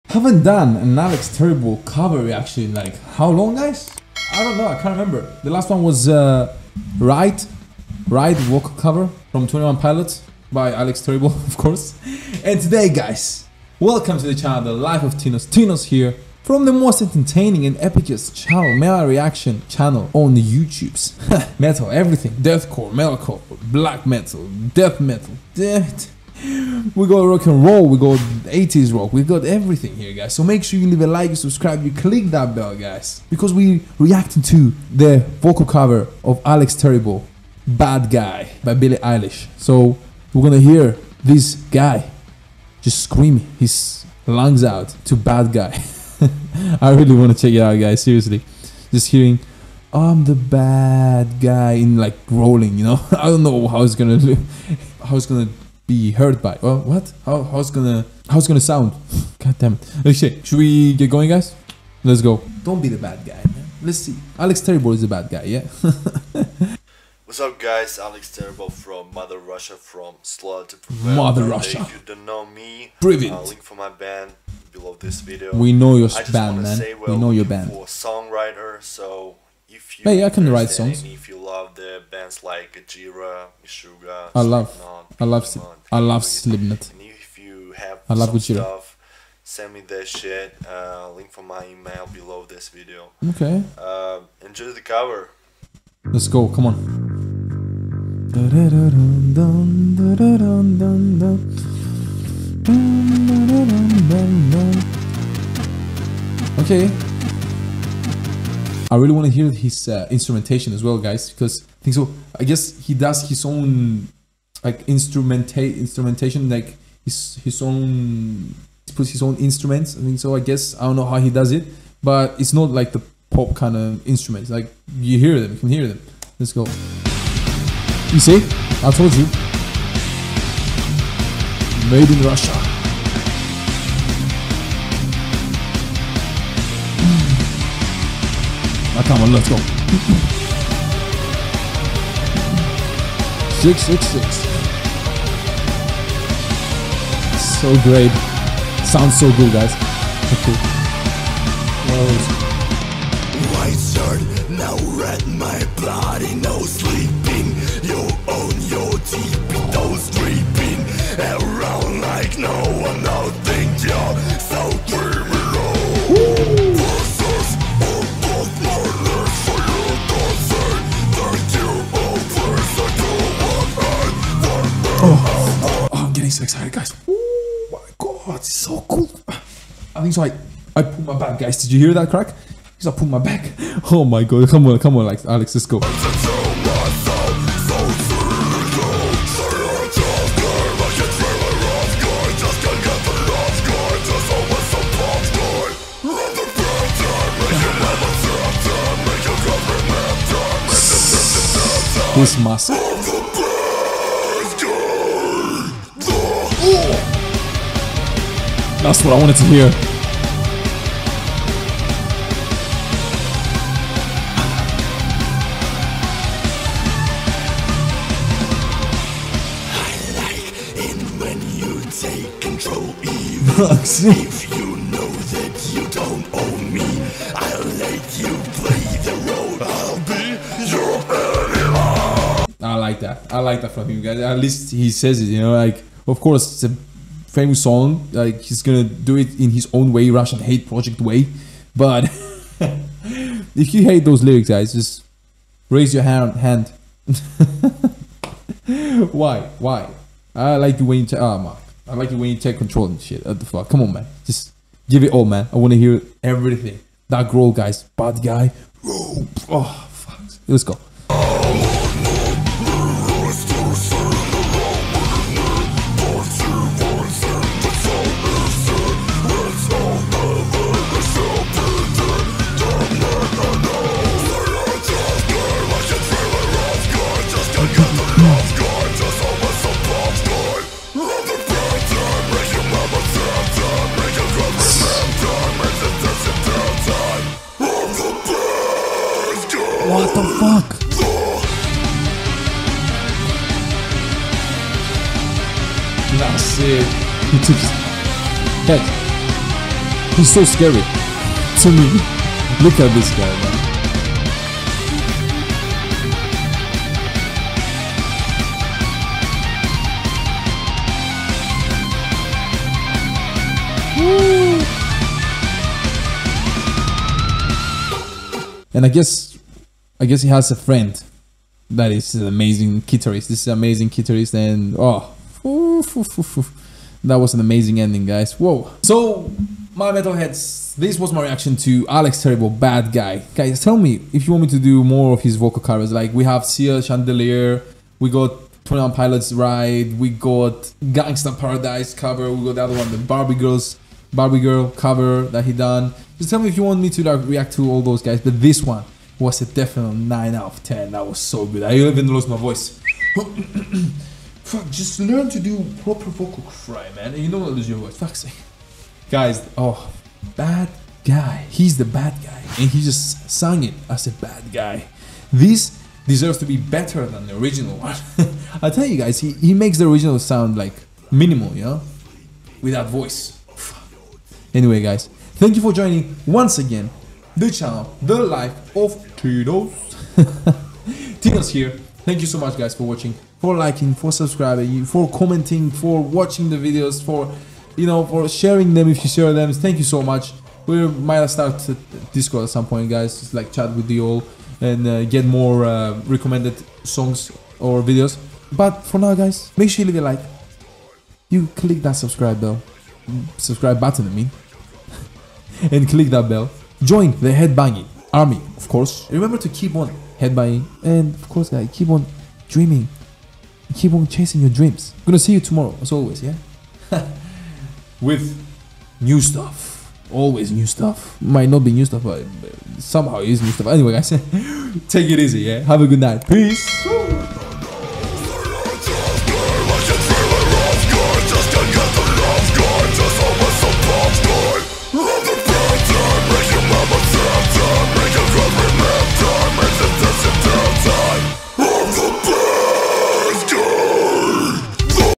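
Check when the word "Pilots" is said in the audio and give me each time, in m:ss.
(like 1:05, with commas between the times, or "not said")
0:09, 5:38.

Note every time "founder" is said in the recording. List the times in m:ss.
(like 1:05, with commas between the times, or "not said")
not said.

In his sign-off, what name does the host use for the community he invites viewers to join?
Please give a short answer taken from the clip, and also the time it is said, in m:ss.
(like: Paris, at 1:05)
the headbanging army, at 6:47.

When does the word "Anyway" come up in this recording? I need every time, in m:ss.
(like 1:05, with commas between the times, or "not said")
6:14, 7:03.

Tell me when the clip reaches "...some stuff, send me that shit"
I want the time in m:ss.
1:28.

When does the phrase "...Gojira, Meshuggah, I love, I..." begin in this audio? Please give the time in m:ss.
1:22.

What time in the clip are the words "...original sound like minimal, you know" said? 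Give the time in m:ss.
6:09.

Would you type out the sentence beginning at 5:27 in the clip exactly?
That was an amazing ending, guys.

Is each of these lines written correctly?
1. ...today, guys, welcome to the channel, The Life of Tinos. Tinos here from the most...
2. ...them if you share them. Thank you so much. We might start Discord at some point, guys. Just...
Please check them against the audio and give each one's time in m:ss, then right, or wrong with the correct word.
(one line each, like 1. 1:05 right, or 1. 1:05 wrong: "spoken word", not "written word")
1. 0:12 right
2. 6:28 right.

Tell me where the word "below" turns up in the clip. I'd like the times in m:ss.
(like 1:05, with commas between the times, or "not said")
1:14, 1:32.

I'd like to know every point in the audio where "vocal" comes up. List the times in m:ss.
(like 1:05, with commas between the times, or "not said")
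0:35, 5:35, 5:56.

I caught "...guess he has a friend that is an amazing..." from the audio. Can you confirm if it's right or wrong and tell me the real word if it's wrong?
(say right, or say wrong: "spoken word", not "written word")
right.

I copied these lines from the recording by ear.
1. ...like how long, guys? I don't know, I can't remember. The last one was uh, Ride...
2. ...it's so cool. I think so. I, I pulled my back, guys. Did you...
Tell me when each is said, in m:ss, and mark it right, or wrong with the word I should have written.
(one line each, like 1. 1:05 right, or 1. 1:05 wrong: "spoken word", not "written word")
1. 0:02 wrong: "Right", not "Ride"
2. 2:58 right.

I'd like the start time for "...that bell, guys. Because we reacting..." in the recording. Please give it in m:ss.
0:32.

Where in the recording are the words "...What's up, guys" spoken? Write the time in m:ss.
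1:07.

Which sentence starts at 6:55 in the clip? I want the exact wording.
gonna see you tomorrow, as always, yeah?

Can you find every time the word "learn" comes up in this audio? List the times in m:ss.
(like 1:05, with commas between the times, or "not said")
5:54.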